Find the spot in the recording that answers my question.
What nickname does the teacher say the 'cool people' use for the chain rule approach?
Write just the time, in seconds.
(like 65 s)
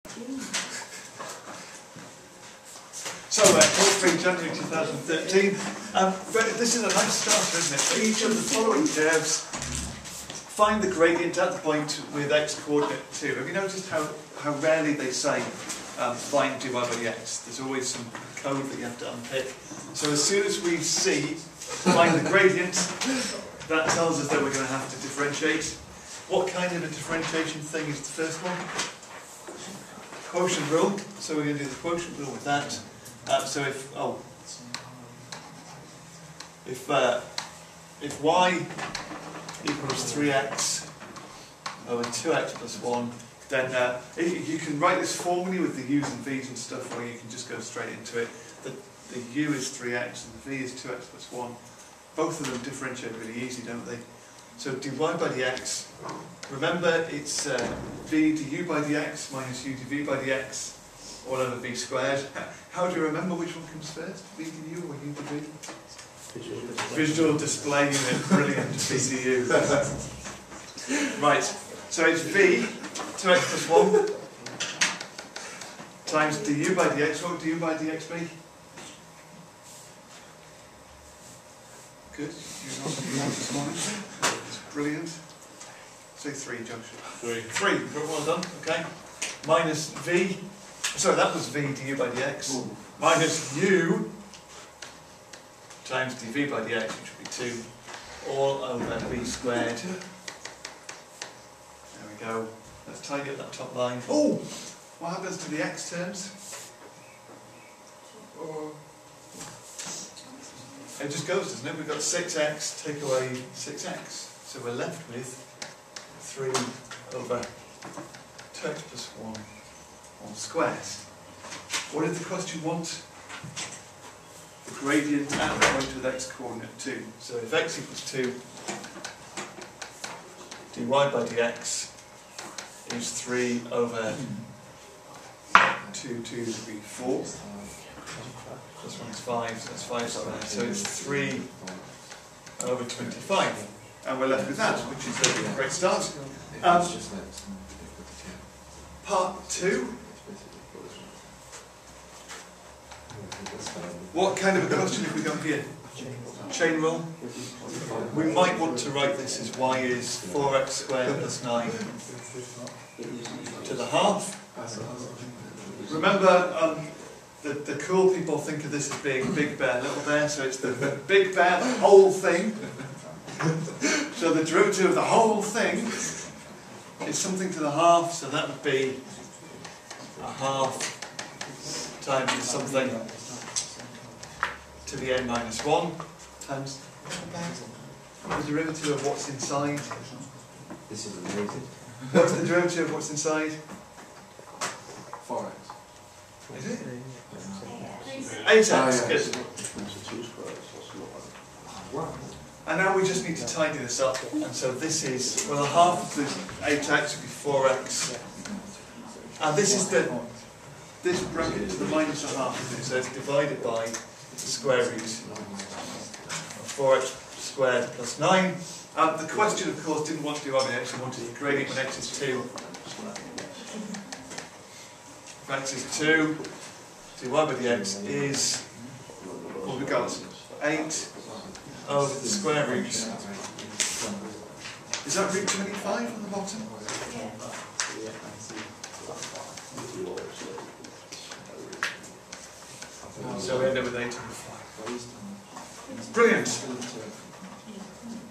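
169 s.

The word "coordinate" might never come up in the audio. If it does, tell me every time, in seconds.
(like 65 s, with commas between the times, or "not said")
12 s, 126 s.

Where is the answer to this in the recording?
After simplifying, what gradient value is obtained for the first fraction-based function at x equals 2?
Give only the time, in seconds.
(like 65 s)
141 s.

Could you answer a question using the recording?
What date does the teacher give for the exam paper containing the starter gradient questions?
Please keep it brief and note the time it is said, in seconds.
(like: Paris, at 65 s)
3 January 2013, at 3 s.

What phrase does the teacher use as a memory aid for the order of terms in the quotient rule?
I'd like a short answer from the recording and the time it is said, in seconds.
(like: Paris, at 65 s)
Visual display unit, at 67 s.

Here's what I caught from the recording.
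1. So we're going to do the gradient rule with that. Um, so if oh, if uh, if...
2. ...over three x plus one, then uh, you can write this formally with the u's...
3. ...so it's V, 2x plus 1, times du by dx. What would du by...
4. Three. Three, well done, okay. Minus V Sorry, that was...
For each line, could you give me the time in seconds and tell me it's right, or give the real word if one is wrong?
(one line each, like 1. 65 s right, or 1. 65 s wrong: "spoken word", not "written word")
1. 31 s wrong: "quotient", not "gradient"
2. 41 s wrong: "two", not "three"
3. 71 s right
4. 87 s right.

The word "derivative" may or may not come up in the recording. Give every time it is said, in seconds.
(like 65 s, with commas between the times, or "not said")
174 s, 188 s, 192 s.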